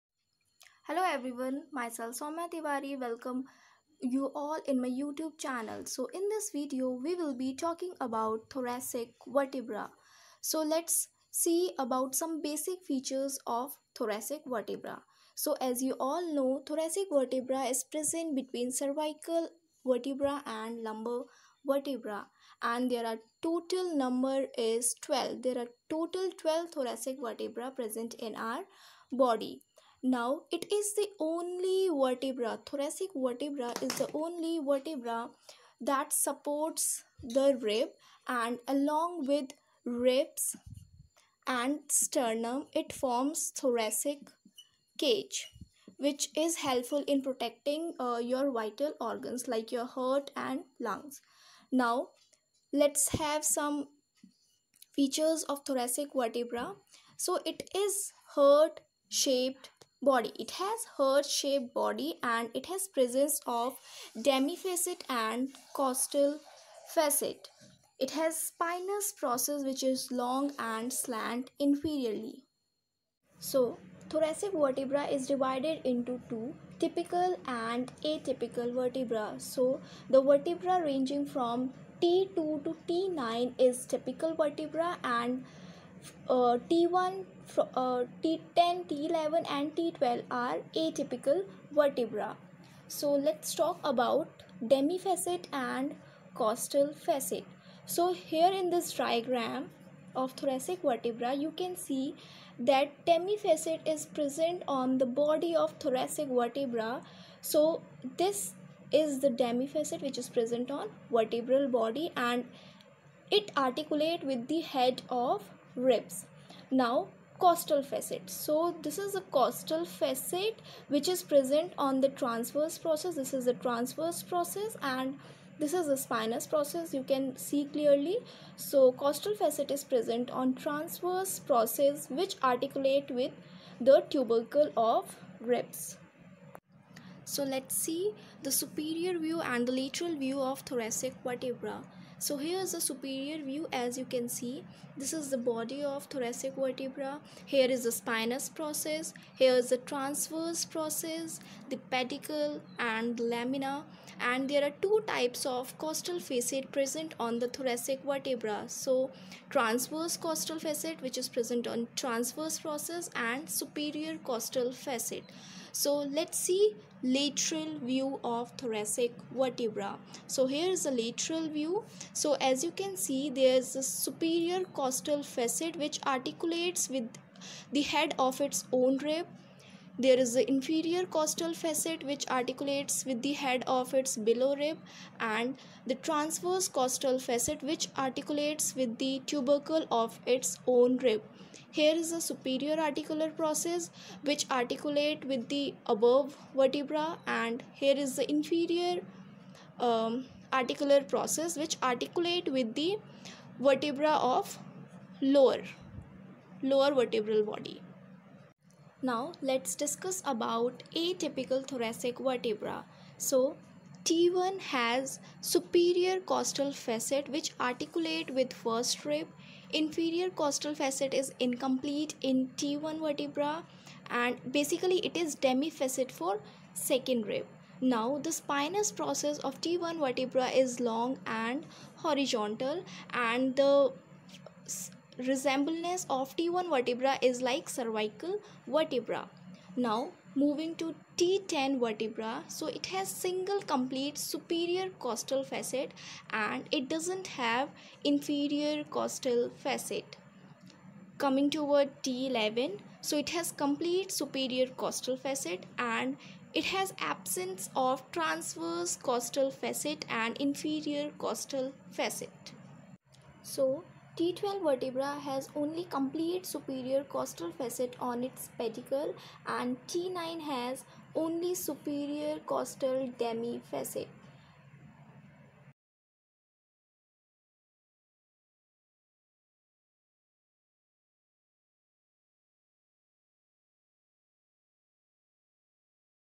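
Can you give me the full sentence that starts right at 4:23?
So T12 vertebra has only complete superior costal facet on its pedicle and T9 has only superior costal demi facet.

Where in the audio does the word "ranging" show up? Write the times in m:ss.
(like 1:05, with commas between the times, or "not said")
1:20.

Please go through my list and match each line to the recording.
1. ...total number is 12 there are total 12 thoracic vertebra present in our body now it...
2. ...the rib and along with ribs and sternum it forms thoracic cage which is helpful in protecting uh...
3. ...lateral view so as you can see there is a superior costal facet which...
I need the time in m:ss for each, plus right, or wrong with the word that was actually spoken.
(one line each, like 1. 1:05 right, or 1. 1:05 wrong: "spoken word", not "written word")
1. 0:23 right
2. 0:37 right
3. 2:50 right.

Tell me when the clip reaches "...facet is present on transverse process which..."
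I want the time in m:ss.
2:09.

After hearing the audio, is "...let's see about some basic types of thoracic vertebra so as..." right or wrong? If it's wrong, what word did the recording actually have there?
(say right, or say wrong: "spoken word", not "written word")
wrong: "features", not "types".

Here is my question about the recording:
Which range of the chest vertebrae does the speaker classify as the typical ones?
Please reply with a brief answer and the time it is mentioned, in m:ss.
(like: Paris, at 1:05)
T2 to T9, at 1:22.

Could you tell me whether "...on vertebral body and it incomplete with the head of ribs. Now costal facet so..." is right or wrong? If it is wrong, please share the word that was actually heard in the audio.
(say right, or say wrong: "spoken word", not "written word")
wrong: "articulate", not "incomplete".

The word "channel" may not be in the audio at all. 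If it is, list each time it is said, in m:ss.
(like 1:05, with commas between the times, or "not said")
0:05.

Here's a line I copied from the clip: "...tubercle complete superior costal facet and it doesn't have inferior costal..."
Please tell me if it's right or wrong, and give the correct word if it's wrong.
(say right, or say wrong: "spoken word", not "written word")
wrong: "single", not "tubercle".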